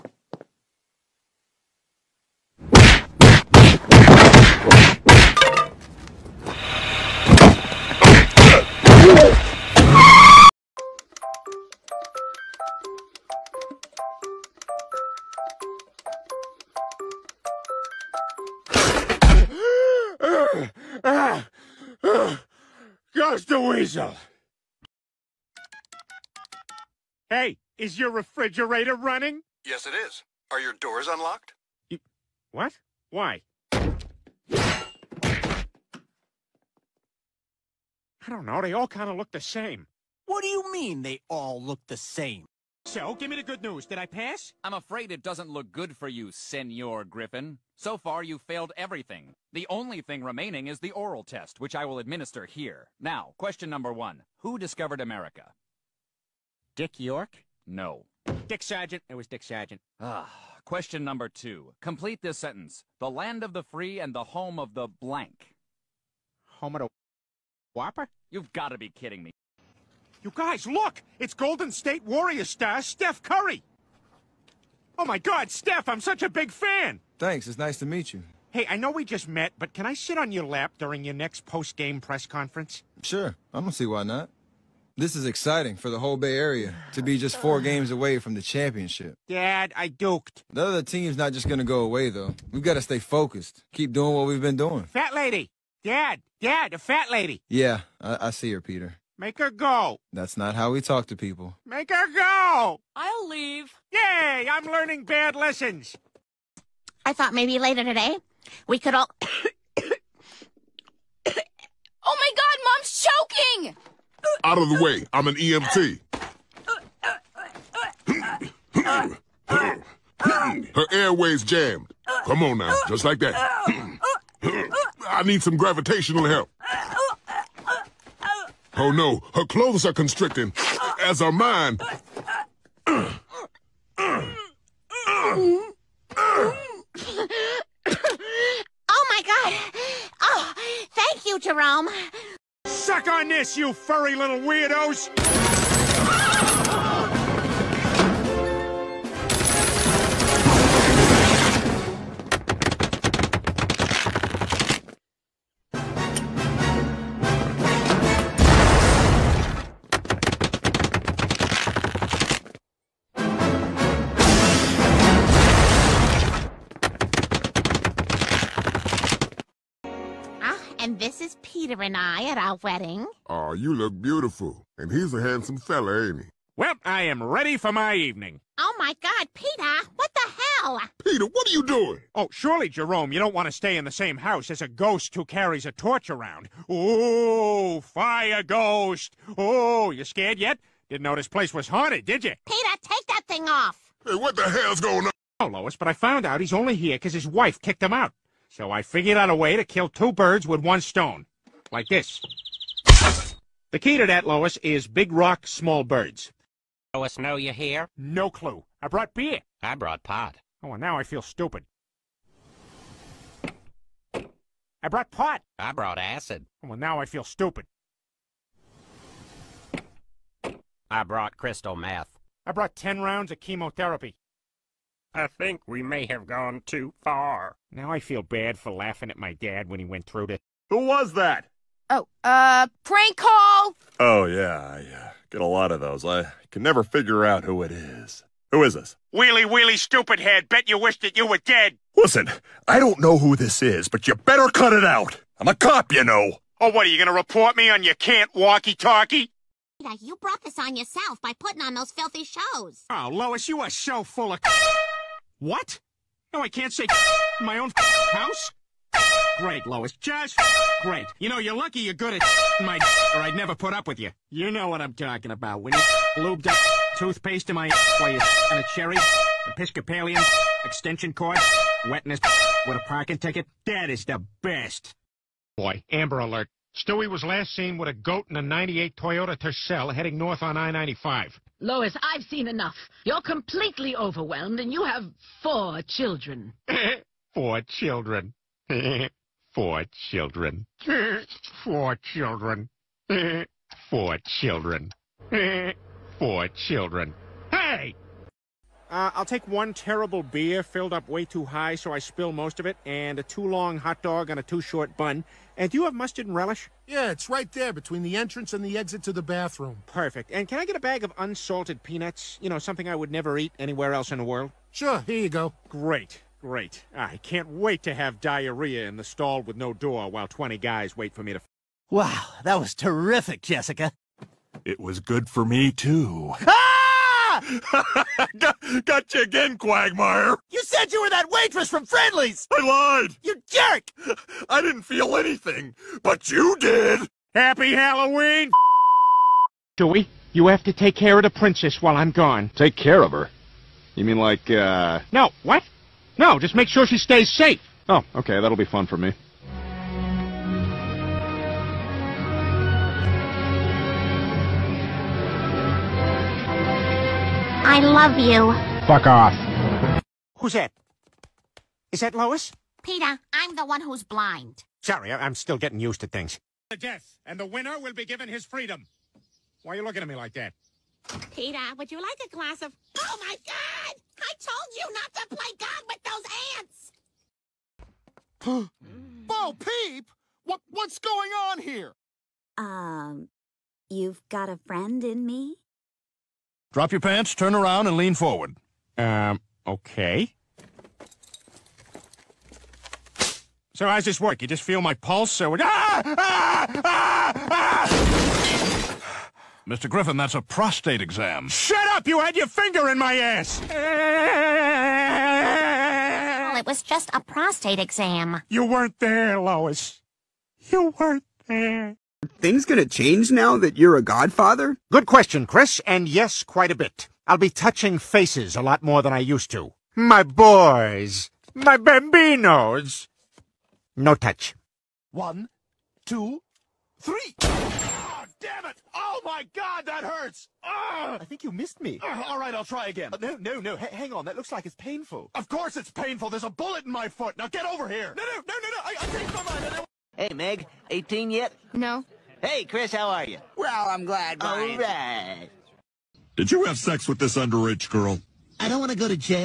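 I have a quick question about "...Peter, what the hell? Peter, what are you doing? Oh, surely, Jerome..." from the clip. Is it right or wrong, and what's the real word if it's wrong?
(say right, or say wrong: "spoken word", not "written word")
right.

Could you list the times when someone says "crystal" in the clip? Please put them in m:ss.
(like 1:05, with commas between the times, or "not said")
3:41.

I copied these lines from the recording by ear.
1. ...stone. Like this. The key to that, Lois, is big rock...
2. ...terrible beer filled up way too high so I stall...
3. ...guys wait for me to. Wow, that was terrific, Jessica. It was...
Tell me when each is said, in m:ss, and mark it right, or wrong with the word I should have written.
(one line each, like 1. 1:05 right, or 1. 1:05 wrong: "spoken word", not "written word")
1. 3:20 right
2. 4:59 wrong: "spill", not "stall"
3. 5:20 right.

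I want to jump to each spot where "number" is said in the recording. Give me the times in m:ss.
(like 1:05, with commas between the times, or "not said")
0:53, 1:01.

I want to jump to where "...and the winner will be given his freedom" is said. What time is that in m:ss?
6:07.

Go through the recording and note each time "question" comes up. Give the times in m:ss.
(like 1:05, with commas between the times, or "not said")
0:53, 1:00, 6:55.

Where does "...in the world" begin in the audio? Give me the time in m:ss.
5:14.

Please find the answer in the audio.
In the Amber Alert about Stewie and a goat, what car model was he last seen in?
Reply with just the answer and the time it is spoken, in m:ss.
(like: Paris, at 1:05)
Toyota Tercel, at 4:38.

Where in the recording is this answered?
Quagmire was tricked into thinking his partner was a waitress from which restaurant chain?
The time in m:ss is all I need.
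5:31.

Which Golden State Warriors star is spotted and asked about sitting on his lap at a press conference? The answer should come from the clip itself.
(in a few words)
Steph Curry.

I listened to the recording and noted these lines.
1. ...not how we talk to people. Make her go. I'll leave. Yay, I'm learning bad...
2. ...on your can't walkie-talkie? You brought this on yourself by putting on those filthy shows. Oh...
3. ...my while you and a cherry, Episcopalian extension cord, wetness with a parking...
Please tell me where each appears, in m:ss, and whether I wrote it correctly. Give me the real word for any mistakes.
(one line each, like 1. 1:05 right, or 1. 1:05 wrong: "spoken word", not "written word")
1. 1:40 right
2. 4:07 right
3. 4:27 right.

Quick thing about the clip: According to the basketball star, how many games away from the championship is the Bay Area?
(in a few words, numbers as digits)
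4.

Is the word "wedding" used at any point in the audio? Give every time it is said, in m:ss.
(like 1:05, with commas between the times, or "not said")
2:52.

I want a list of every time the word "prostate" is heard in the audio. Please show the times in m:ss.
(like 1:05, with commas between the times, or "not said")
6:40, 6:47.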